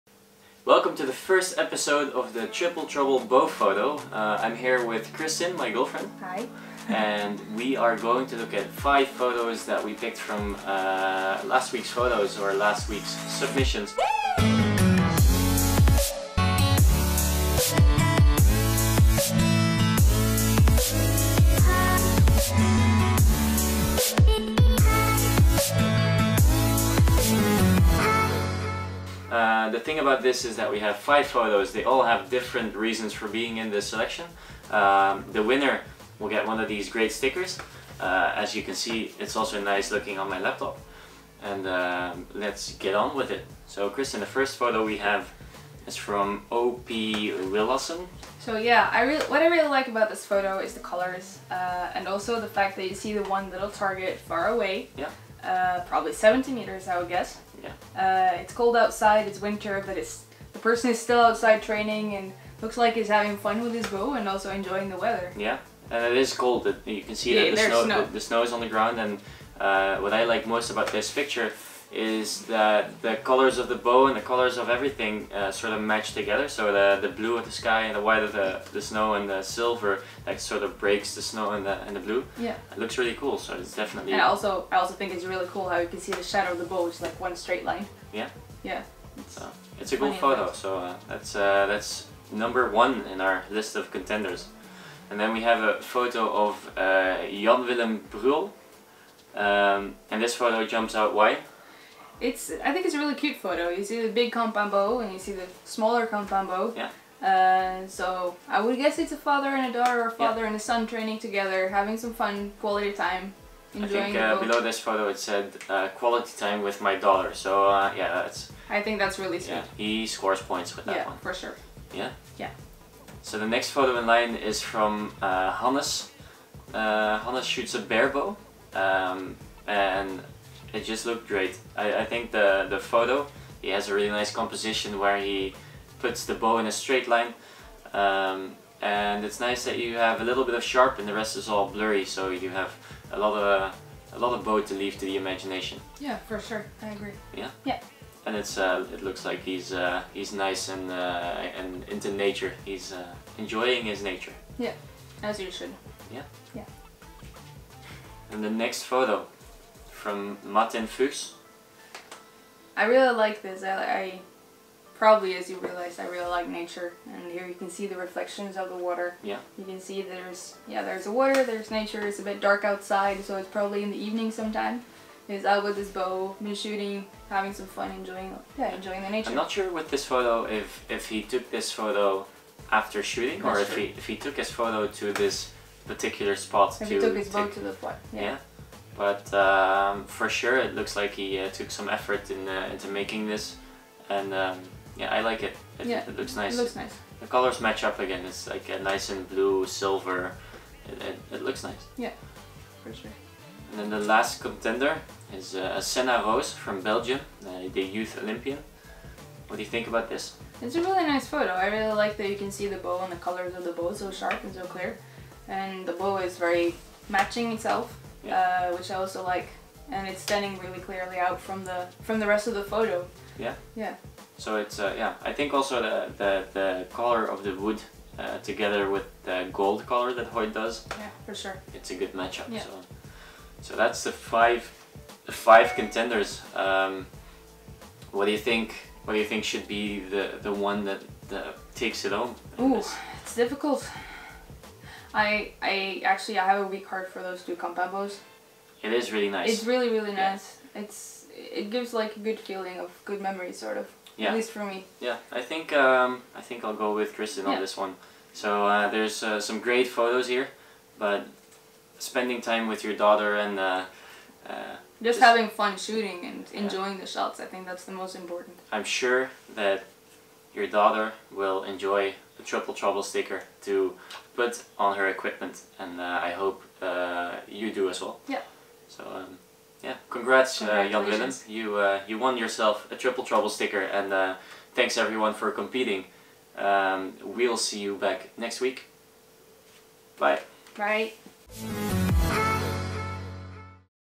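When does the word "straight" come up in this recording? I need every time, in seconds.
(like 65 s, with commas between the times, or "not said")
87 s, 136 s.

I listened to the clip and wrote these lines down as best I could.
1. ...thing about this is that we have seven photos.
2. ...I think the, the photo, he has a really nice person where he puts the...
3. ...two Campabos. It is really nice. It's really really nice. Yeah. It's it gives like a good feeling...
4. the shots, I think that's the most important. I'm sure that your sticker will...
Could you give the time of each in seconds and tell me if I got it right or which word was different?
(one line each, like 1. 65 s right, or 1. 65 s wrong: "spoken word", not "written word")
1. 29 s wrong: "five", not "seven"
2. 131 s wrong: "composition", not "person"
3. 247 s right
4. 267 s wrong: "daughter", not "sticker".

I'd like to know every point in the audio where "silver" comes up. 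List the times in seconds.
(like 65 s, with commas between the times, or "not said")
79 s, 199 s.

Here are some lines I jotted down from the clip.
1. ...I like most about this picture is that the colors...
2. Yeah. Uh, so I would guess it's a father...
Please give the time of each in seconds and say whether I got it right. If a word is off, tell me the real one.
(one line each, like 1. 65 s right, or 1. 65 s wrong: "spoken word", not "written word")
1. 70 s right
2. 106 s right.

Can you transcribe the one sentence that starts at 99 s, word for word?
Um, and this photo jumps out why?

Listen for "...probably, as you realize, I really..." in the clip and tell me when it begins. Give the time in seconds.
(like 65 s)
164 s.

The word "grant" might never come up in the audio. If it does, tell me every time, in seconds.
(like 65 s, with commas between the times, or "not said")
not said.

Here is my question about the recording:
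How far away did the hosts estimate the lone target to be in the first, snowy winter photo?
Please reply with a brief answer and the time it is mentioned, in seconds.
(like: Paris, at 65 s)
70 meters, at 56 s.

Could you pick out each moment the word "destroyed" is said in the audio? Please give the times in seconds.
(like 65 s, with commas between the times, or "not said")
not said.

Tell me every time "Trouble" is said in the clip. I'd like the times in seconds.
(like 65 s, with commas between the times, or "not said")
2 s, 272 s, 283 s.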